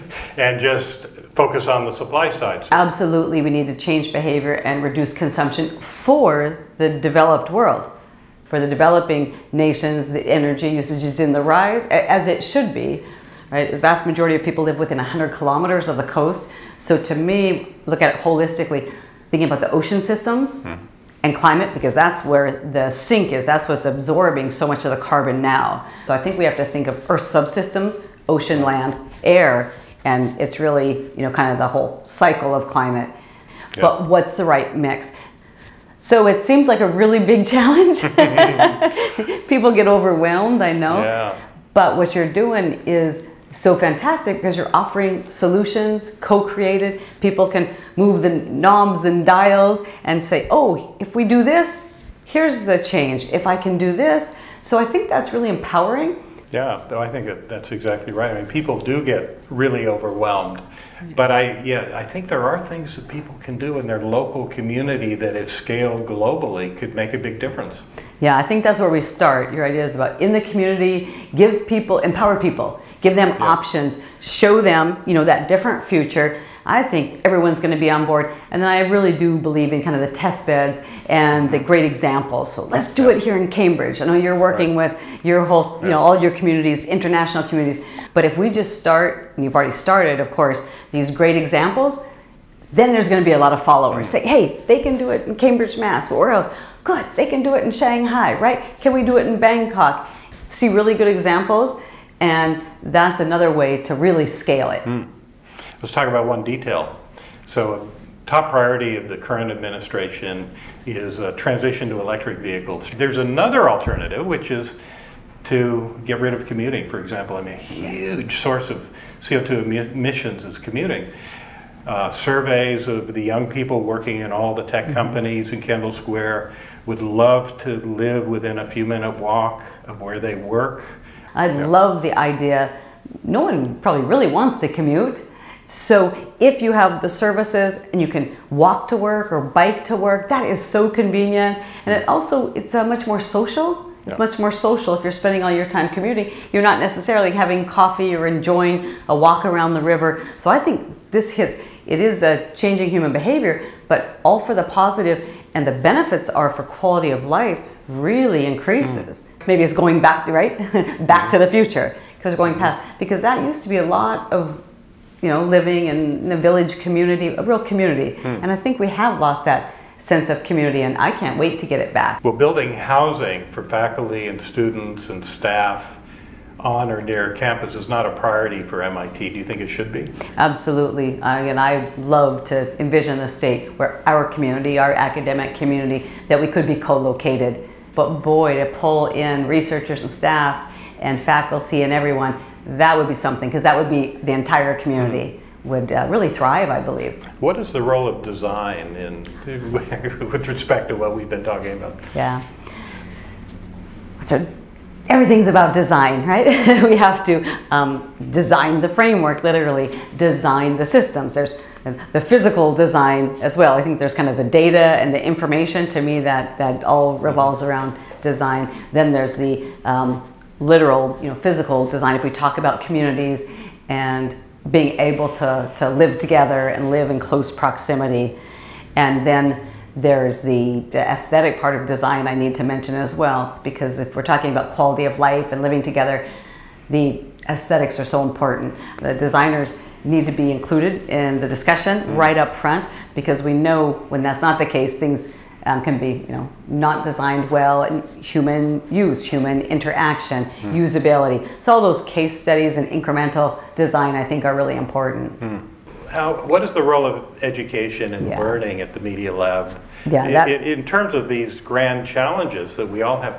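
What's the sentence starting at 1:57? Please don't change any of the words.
I mean, a huge source of CO2 emissions is commuting.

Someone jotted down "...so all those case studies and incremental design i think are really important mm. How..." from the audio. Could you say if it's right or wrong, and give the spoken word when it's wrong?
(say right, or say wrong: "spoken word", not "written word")
right.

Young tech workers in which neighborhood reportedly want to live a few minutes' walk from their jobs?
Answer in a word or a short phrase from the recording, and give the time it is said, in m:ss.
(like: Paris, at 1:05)
Kendall Square, at 2:05.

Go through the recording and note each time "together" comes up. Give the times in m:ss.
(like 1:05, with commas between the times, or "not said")
3:46, 3:55.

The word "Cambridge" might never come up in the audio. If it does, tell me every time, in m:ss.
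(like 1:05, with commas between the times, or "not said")
1:23, 1:35.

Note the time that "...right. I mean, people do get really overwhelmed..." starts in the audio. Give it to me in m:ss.
0:58.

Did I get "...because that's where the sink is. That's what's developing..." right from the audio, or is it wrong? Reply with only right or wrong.
wrong.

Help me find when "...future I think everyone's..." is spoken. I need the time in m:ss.
1:15.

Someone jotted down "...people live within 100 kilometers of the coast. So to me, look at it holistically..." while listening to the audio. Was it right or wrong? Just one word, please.
right.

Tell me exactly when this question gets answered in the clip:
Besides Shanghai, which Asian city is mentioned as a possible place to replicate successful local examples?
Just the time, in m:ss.
1:39.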